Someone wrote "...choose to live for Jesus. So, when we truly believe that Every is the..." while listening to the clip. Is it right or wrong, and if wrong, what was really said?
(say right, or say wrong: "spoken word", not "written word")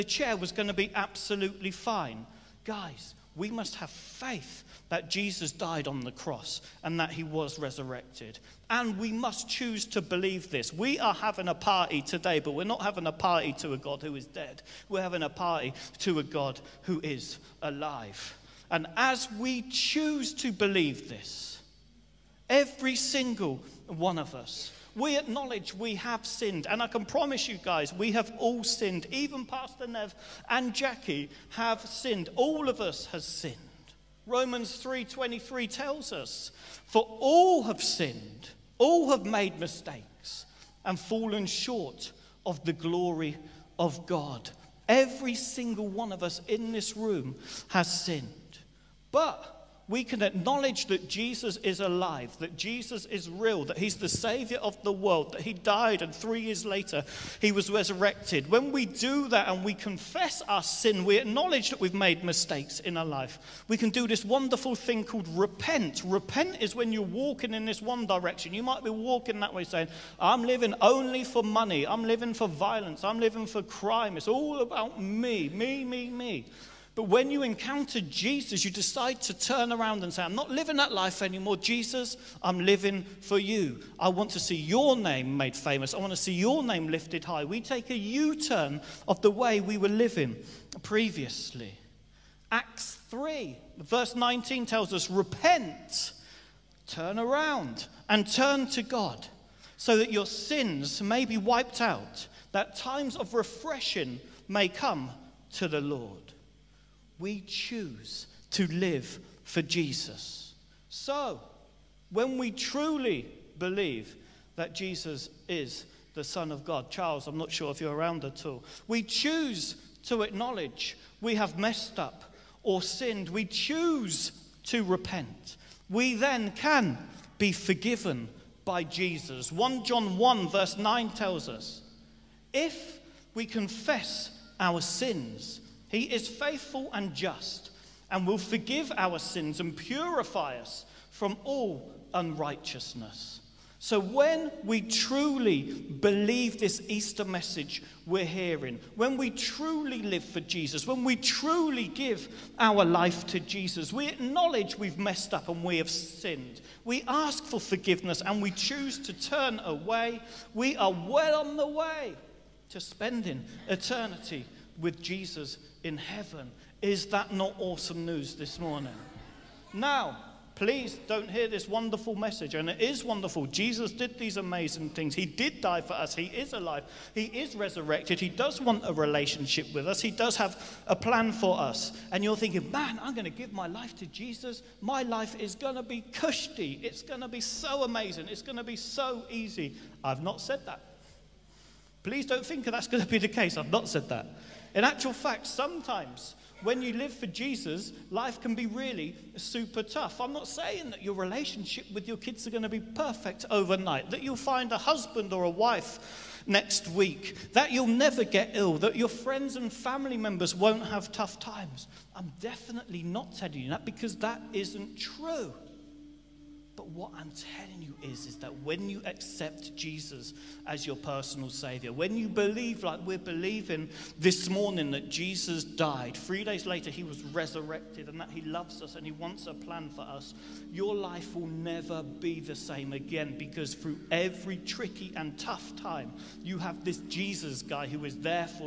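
wrong: "Jesus", not "Every".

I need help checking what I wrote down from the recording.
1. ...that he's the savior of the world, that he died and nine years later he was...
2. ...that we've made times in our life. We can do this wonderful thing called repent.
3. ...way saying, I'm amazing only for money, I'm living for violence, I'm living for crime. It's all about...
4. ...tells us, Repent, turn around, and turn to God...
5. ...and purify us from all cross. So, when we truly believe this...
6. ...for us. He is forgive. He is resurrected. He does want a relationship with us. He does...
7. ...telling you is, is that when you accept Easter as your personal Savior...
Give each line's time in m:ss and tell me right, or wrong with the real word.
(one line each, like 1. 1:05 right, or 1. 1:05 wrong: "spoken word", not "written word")
1. 0:53 wrong: "three", not "nine"
2. 1:01 wrong: "mistakes", not "times"
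3. 1:09 wrong: "living", not "amazing"
4. 1:34 right
5. 2:19 wrong: "unrighteousness", not "cross"
6. 2:55 wrong: "alive", not "forgive"
7. 3:37 wrong: "Jesus", not "Easter".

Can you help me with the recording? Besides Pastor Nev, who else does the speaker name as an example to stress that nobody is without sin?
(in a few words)
Jackie.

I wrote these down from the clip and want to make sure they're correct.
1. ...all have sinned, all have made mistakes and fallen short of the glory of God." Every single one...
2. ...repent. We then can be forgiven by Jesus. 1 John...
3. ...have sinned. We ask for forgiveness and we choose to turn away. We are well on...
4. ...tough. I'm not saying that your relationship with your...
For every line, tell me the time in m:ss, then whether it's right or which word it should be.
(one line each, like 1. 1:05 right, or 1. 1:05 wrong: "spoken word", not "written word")
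1. 0:37 right
2. 2:04 right
3. 2:35 right
4. 3:19 right.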